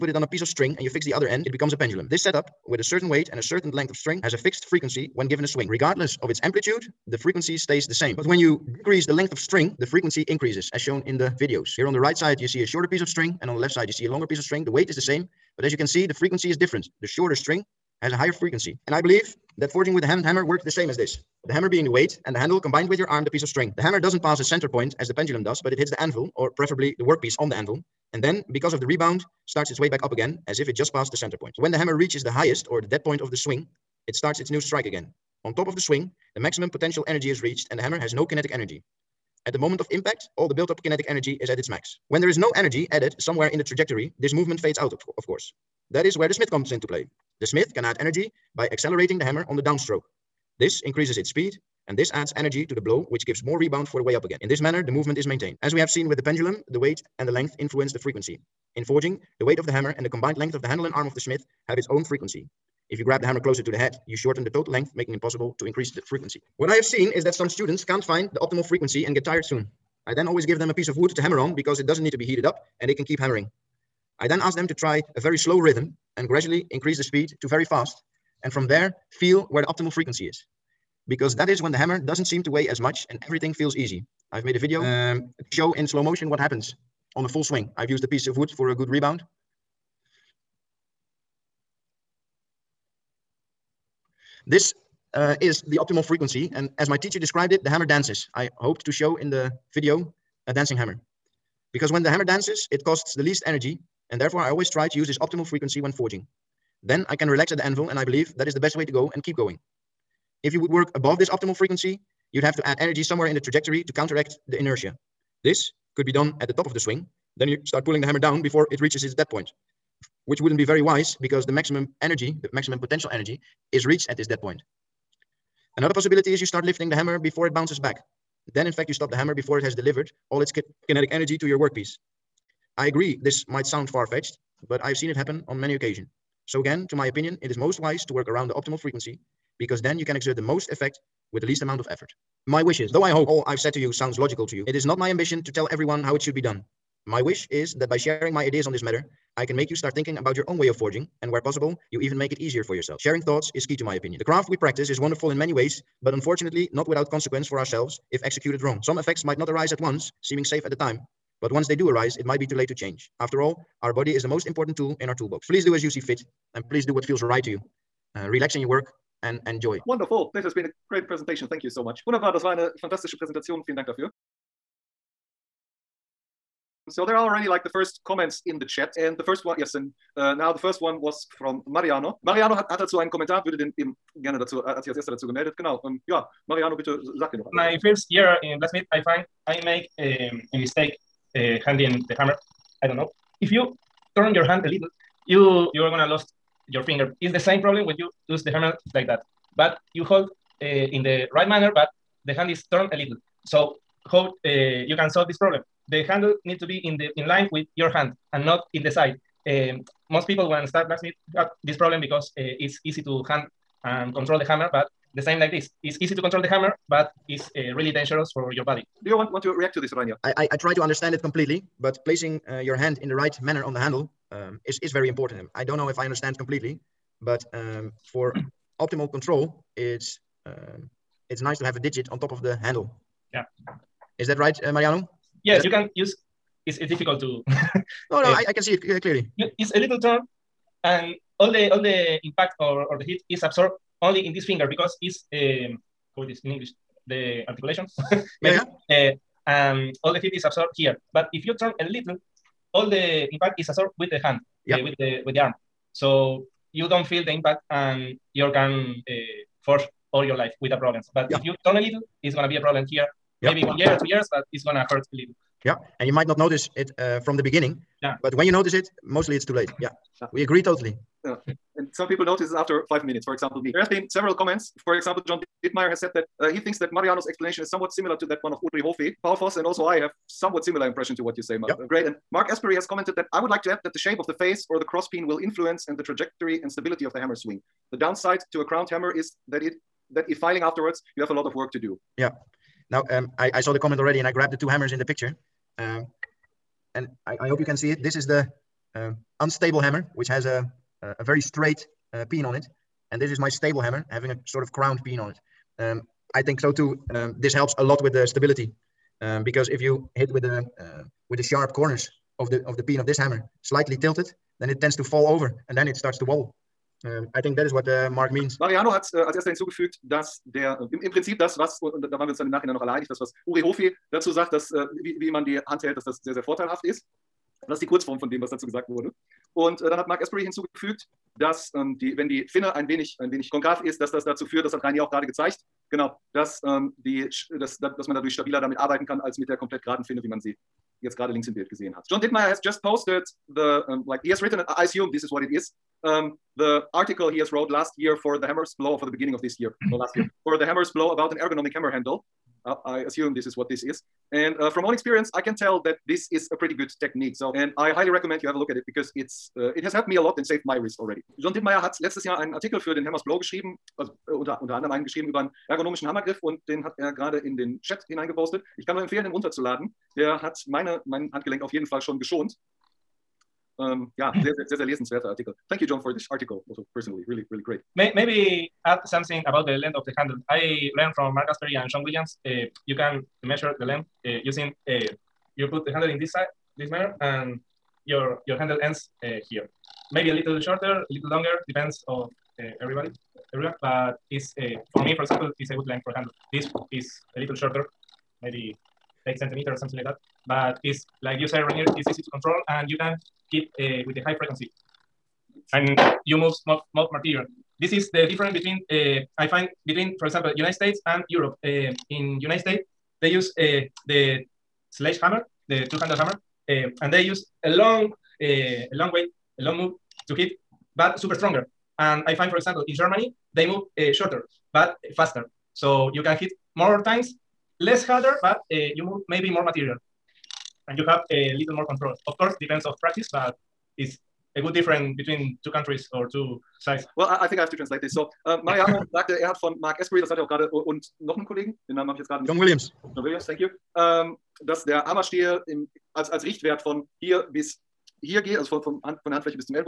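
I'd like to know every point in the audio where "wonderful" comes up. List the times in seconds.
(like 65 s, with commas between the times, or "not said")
154 s, 169 s.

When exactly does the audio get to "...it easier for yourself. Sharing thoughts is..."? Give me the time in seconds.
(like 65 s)
152 s.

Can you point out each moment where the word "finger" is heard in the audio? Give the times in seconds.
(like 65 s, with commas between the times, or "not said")
196 s, 244 s.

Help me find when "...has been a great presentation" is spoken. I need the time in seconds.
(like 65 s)
170 s.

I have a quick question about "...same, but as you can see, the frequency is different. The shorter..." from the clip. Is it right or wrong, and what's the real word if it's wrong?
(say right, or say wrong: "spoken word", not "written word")
right.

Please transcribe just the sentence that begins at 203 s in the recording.
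So how uh, you can solve this problem.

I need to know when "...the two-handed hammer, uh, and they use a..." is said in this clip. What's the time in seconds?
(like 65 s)
415 s.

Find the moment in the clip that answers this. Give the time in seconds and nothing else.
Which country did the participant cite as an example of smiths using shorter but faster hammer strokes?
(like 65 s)
422 s.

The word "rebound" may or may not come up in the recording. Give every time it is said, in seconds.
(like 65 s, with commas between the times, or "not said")
28 s, 53 s, 88 s.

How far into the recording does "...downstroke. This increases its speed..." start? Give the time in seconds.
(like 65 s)
49 s.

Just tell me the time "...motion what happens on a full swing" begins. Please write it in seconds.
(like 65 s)
86 s.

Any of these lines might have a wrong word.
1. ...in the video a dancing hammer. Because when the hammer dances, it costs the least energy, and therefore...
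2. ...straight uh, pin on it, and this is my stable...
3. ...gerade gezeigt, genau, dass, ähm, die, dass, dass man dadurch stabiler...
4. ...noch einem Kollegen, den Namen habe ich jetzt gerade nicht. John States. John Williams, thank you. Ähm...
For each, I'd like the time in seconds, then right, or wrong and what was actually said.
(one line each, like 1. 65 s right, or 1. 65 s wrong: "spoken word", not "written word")
1. 99 s right
2. 301 s right
3. 335 s right
4. 441 s wrong: "Williams", not "States".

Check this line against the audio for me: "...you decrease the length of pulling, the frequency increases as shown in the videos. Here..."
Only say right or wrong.
wrong.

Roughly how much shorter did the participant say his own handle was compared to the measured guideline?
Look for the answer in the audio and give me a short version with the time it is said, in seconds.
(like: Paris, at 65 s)
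8 centimeters, at 399 s.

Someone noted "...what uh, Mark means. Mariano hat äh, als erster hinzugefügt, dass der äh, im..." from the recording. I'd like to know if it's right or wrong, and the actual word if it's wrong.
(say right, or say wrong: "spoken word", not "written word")
right.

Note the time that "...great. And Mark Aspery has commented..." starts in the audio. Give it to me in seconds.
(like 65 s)
281 s.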